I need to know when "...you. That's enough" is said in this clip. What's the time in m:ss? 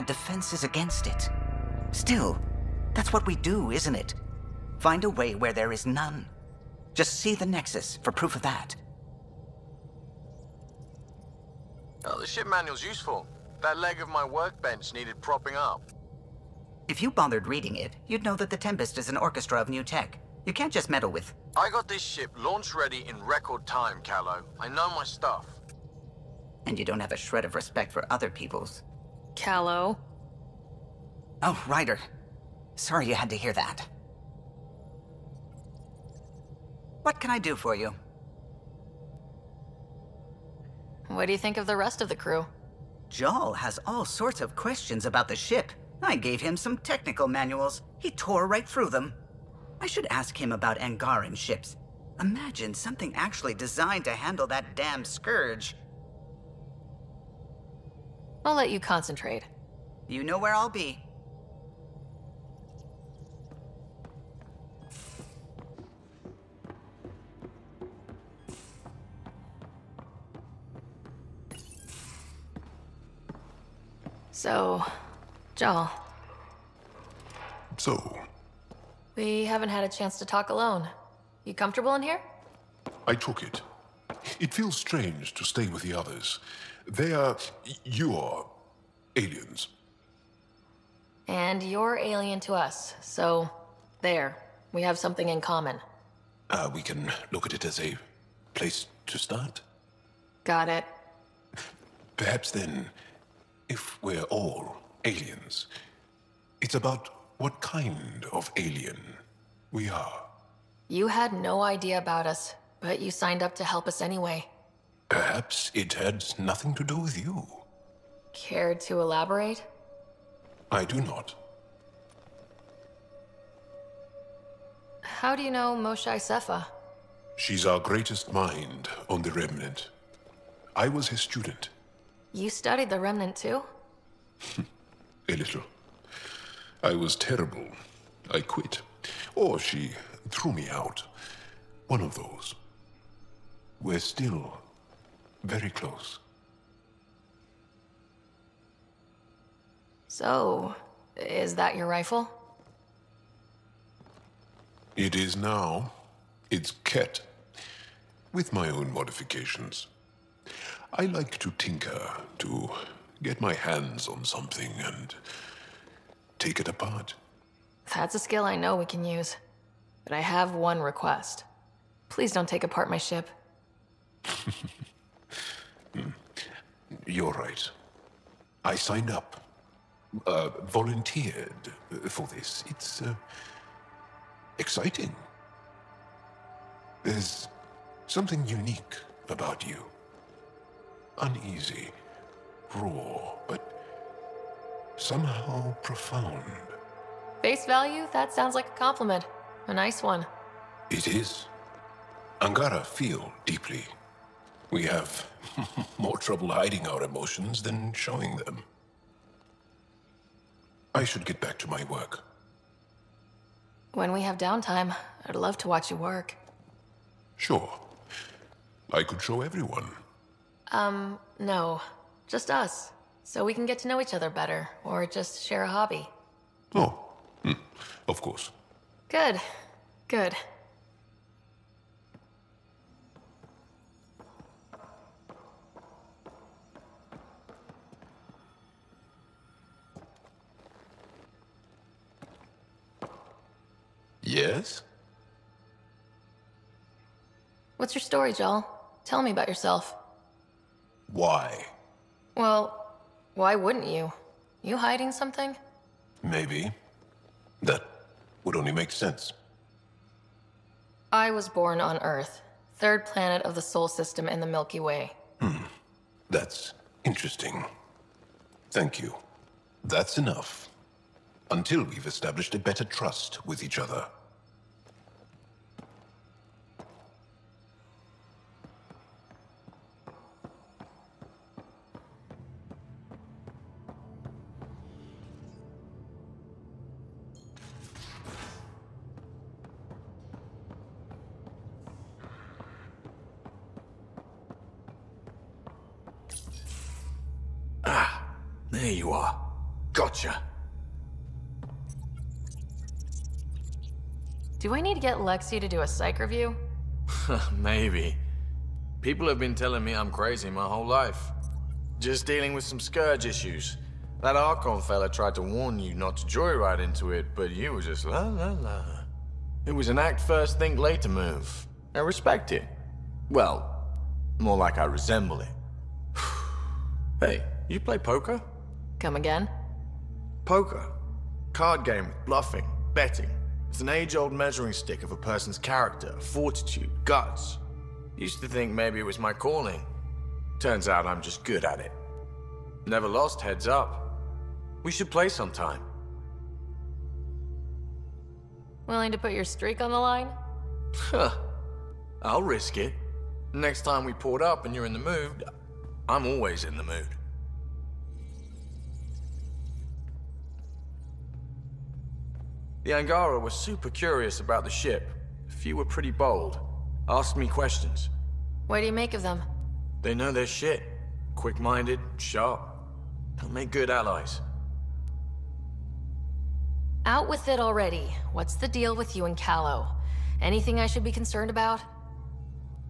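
4:28.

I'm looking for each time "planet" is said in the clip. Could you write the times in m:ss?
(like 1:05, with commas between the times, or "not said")
4:23.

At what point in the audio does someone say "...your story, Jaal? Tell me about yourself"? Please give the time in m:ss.
4:07.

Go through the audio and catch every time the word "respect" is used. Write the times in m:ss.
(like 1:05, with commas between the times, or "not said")
0:27, 5:21.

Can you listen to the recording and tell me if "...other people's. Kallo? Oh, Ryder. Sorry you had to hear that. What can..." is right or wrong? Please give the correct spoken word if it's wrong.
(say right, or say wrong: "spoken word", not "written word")
right.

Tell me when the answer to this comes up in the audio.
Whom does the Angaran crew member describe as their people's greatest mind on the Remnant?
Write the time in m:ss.
2:05.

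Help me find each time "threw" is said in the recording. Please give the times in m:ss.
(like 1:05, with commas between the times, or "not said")
2:20.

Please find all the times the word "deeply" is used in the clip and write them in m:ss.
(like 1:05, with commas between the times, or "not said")
3:23.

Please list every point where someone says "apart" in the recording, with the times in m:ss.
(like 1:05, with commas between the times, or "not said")
2:46, 2:52.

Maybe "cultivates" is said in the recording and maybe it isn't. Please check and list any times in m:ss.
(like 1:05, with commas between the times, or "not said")
not said.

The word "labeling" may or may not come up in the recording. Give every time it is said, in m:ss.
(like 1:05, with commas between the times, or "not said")
not said.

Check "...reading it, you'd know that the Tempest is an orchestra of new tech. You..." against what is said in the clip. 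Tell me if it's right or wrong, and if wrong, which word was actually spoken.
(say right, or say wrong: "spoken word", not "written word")
right.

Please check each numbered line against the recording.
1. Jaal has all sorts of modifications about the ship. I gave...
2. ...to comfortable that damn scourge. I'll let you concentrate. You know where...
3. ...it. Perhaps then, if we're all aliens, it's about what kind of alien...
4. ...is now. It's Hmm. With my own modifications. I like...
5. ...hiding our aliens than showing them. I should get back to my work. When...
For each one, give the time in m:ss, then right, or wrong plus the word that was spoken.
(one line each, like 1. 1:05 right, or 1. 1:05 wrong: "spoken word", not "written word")
1. 0:43 wrong: "questions", not "modifications"
2. 0:54 wrong: "handle", not "comfortable"
3. 1:40 right
4. 2:35 wrong: "Kett", not "Hmm"
5. 3:26 wrong: "emotions", not "aliens".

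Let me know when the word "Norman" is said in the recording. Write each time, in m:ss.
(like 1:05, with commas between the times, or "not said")
not said.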